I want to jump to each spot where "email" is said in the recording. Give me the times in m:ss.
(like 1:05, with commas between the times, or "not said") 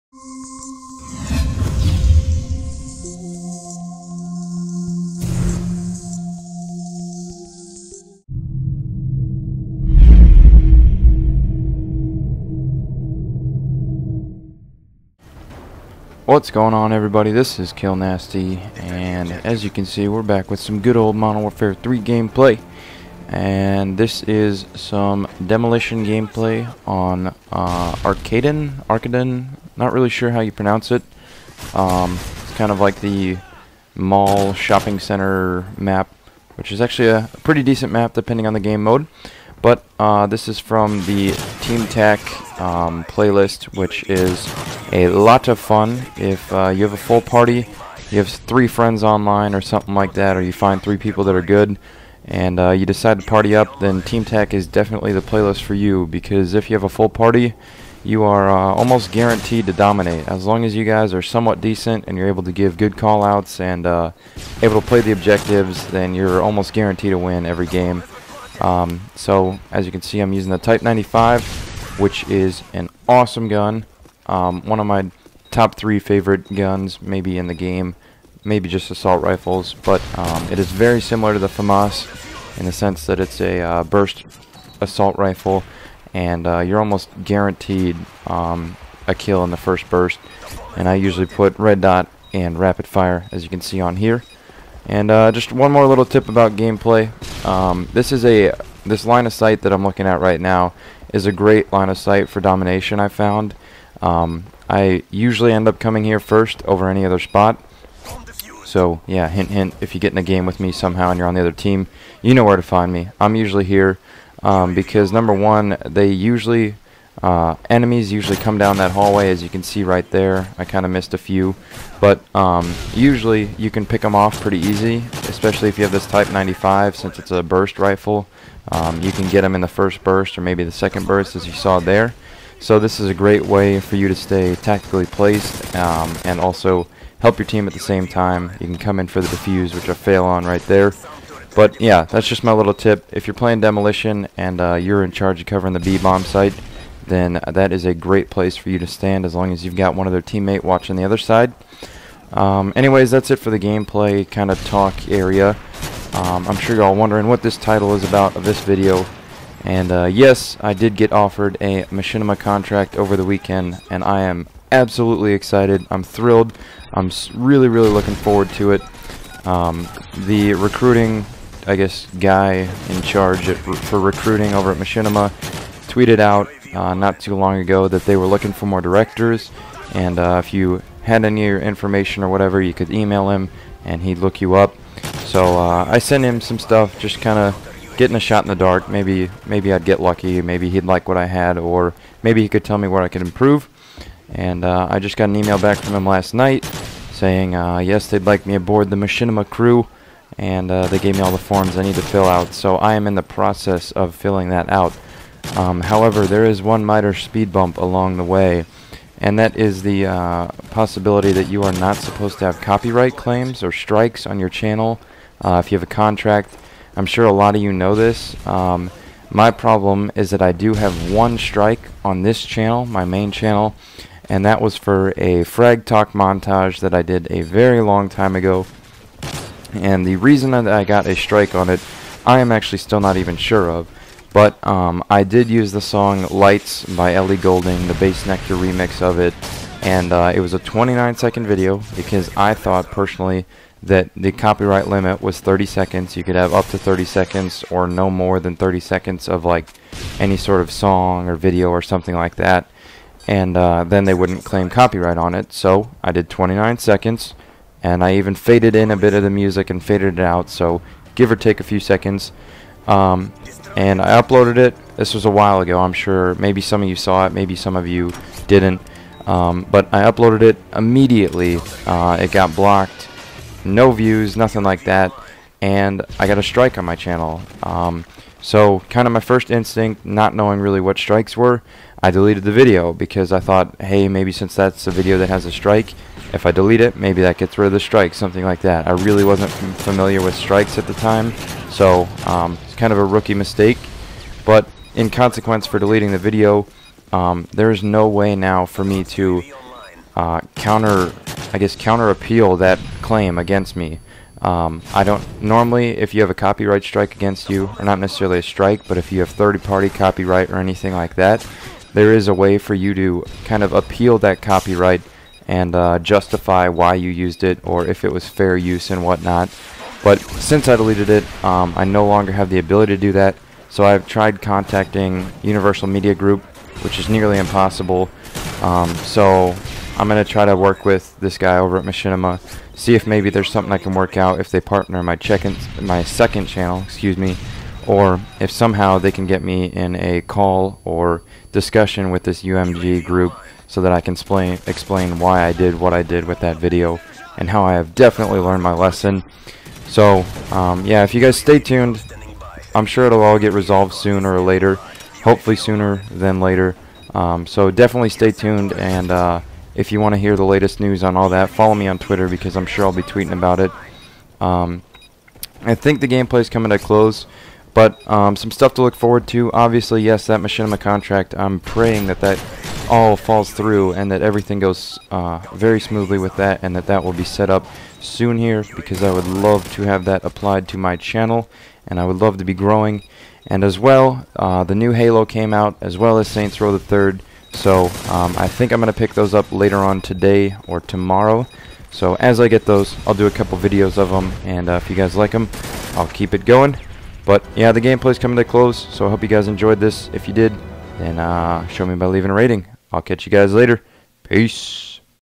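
3:02, 3:15.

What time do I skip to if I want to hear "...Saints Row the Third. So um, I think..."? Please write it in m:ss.
6:26.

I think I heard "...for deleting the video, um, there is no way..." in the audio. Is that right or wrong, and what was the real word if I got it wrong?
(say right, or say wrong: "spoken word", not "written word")
right.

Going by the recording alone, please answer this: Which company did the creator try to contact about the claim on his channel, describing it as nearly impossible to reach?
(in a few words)
Universal Media Group.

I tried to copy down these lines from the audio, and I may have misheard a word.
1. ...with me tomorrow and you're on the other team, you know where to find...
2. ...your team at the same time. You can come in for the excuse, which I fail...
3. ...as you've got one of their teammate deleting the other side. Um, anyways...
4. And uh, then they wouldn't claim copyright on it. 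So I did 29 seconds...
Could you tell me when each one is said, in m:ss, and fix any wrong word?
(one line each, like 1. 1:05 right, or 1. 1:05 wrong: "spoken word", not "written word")
1. 1:50 wrong: "somehow", not "tomorrow"
2. 2:17 wrong: "defuse", not "excuse"
3. 2:29 wrong: "watching", not "deleting"
4. 4:13 right.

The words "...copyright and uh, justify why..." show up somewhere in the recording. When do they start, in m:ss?
5:14.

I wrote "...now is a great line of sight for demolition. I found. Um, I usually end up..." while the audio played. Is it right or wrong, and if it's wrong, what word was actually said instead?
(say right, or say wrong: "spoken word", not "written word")
wrong: "domination", not "demolition".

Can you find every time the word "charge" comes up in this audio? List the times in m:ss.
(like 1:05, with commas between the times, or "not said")
2:25, 2:53.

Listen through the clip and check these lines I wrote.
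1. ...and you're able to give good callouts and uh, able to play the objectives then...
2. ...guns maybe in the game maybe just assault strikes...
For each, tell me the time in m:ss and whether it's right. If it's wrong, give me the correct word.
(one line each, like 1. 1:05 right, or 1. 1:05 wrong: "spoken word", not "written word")
1. 1:02 right
2. 1:16 wrong: "rifles", not "strikes".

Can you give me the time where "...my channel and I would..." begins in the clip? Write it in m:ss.
6:20.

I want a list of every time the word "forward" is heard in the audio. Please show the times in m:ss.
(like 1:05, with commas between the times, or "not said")
2:48, 6:08.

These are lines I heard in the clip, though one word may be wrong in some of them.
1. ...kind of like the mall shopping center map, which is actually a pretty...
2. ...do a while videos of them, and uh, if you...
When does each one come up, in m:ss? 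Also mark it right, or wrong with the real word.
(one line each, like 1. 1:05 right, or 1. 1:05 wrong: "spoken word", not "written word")
1. 0:32 right
2. 6:33 wrong: "couple", not "while".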